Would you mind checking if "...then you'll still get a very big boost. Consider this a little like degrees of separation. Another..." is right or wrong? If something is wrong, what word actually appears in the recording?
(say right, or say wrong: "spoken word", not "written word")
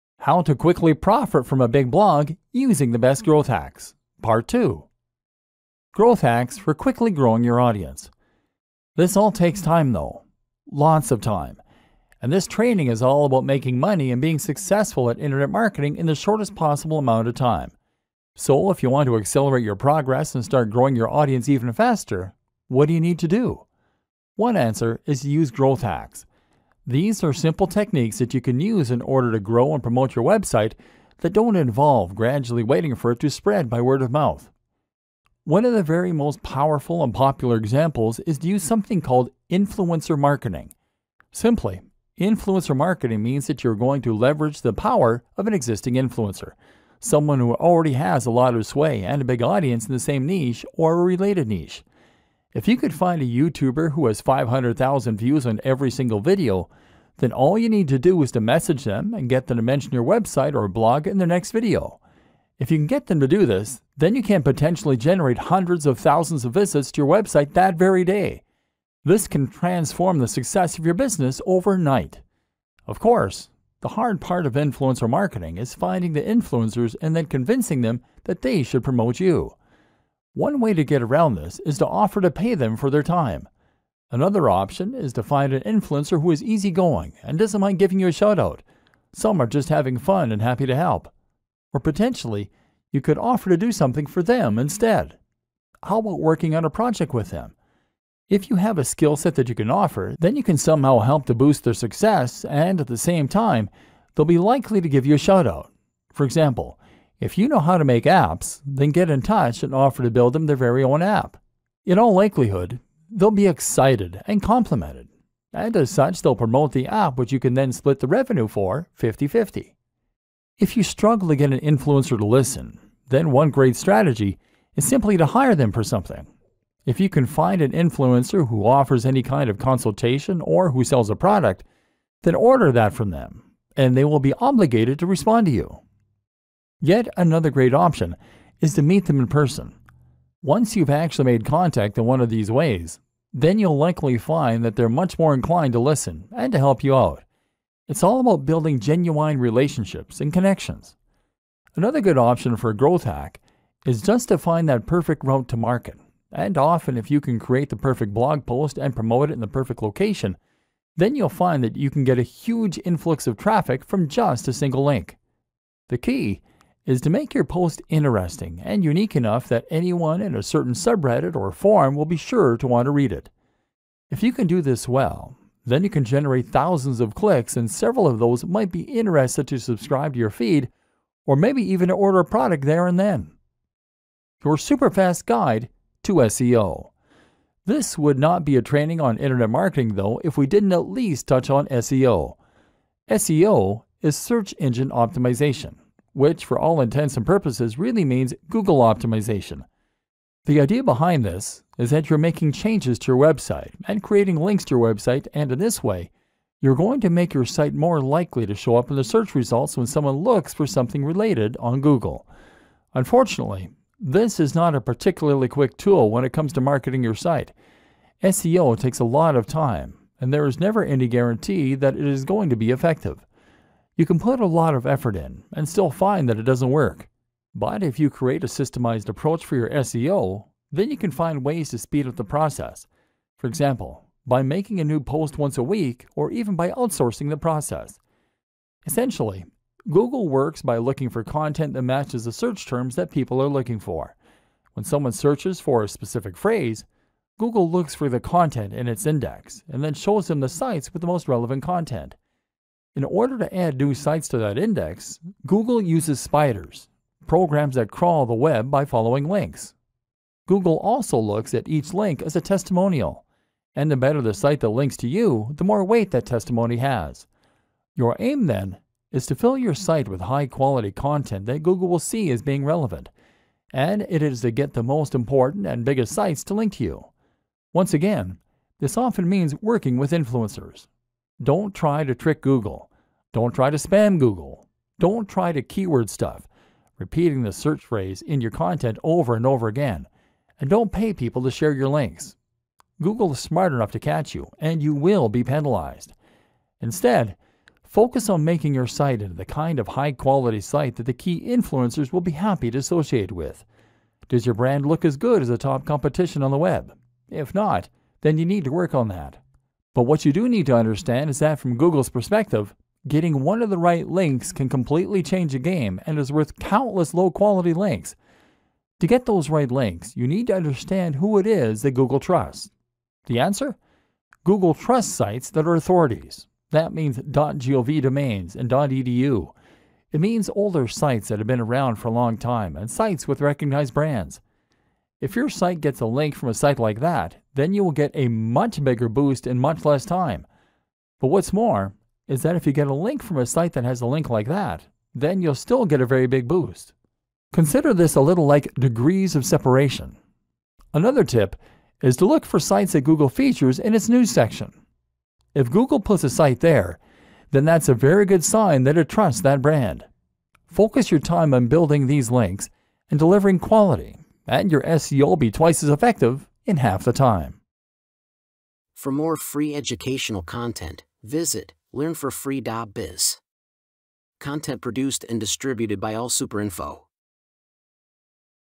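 right.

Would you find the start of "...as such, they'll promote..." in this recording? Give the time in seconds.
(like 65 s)
115 s.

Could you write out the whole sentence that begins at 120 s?
If you struggle to get an influencer to listen, then one great strategy is simply to hire them for something.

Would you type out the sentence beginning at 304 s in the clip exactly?
Does your brand look as good as the top competition on the web?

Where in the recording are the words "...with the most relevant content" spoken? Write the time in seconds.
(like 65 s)
250 s.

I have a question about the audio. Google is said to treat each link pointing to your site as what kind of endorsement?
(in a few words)
testimonial.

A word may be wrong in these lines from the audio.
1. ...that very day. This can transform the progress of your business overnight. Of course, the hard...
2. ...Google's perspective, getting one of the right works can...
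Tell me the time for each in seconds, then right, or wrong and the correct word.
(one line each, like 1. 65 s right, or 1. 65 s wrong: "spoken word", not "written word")
1. 67 s wrong: "success", not "progress"
2. 311 s wrong: "links", not "works".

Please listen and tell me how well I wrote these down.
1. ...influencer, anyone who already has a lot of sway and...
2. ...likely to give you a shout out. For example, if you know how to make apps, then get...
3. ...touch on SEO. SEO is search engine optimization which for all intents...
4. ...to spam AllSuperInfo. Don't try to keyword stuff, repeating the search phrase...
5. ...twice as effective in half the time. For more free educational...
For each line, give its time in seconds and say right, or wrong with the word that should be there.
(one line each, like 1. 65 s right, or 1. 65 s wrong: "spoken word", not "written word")
1. 45 s wrong: "someone", not "anyone"
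2. 104 s right
3. 191 s right
4. 283 s wrong: "Google", not "AllSuperInfo"
5. 365 s right.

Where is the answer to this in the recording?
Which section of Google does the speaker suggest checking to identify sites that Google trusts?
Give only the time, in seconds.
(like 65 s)
354 s.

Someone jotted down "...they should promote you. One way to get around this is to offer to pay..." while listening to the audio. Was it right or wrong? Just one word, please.
right.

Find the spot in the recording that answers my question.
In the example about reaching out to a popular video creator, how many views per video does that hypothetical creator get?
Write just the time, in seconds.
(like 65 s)
54 s.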